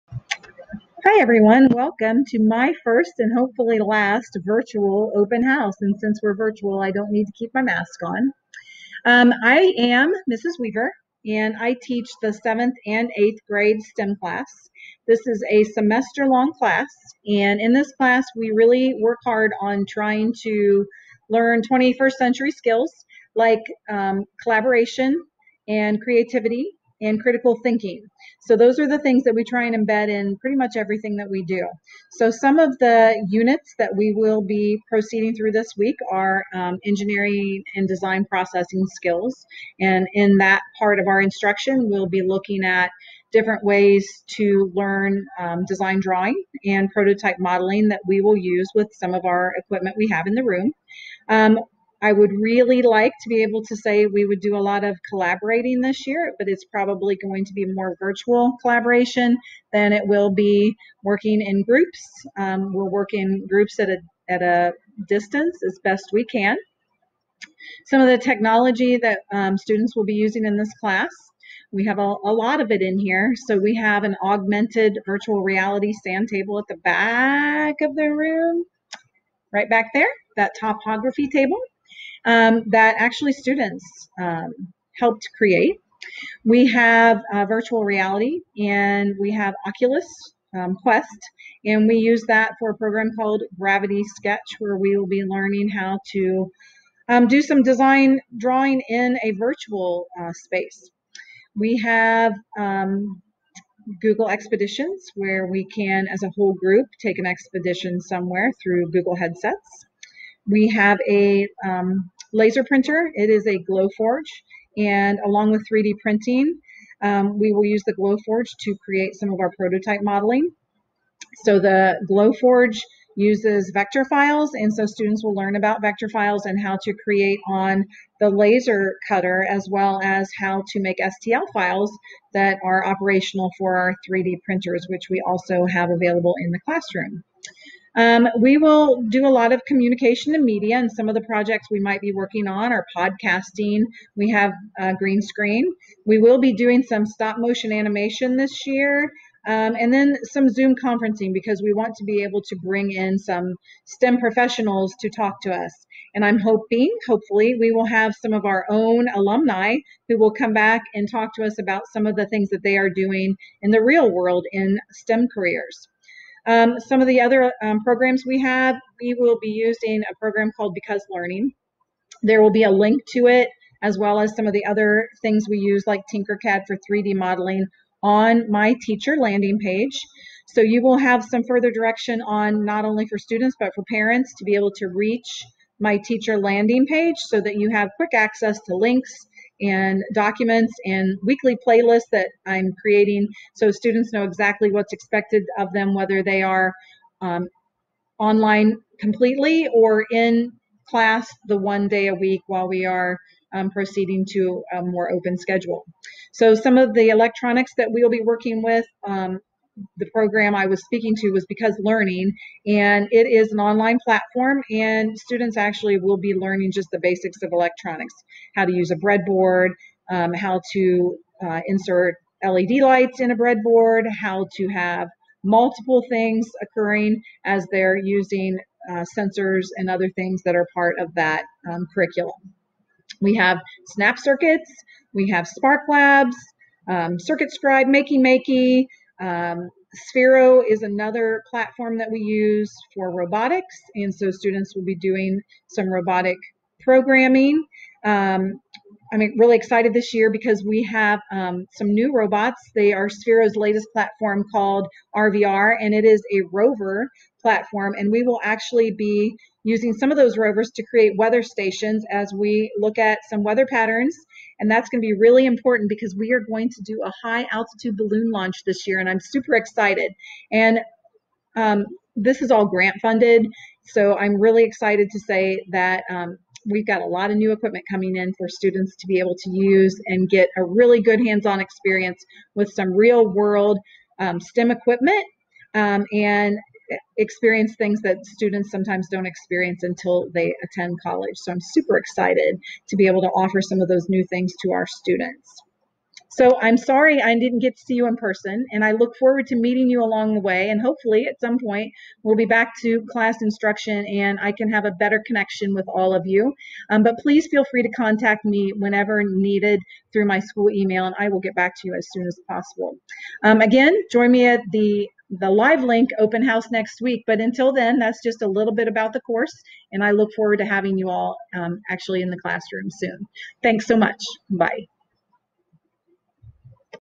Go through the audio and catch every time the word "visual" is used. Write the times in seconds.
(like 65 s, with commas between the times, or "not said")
not said.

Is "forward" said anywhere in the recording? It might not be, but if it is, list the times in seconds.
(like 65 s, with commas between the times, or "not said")
299 s, 320 s.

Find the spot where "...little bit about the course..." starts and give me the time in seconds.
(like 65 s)
318 s.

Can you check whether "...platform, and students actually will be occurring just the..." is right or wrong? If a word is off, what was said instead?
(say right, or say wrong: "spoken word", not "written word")
wrong: "learning", not "occurring".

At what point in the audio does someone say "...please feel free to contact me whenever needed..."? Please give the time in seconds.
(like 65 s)
307 s.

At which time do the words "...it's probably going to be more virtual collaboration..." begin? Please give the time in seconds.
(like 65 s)
56 s.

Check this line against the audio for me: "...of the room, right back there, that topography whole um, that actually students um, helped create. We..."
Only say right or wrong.
wrong.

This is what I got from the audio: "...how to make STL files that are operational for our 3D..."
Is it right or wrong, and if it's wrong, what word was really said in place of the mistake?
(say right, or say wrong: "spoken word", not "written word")
right.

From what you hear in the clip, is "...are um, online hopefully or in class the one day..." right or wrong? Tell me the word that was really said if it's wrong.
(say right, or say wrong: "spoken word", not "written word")
wrong: "completely", not "hopefully".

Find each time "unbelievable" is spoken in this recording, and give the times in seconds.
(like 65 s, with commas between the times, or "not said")
not said.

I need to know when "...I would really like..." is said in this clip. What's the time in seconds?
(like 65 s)
52 s.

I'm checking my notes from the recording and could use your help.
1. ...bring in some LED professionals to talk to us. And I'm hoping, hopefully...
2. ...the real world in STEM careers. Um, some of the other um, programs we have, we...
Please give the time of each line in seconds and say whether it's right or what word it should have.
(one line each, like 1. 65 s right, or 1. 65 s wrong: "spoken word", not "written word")
1. 152 s wrong: "STEM", not "LED"
2. 163 s right.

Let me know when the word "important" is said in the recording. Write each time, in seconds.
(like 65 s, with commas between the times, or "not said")
265 s.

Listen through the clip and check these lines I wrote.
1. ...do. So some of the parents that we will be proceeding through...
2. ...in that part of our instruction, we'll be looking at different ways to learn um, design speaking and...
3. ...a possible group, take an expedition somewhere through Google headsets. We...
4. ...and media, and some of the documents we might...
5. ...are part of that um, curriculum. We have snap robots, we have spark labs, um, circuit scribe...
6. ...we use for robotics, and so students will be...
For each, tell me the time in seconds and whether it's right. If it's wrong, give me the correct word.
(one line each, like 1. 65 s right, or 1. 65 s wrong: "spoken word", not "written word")
1. 31 s wrong: "units", not "parents"
2. 40 s wrong: "drawing", not "speaking"
3. 106 s wrong: "whole", not "possible"
4. 140 s wrong: "projects", not "documents"
5. 230 s wrong: "circuits", not "robots"
6. 242 s right.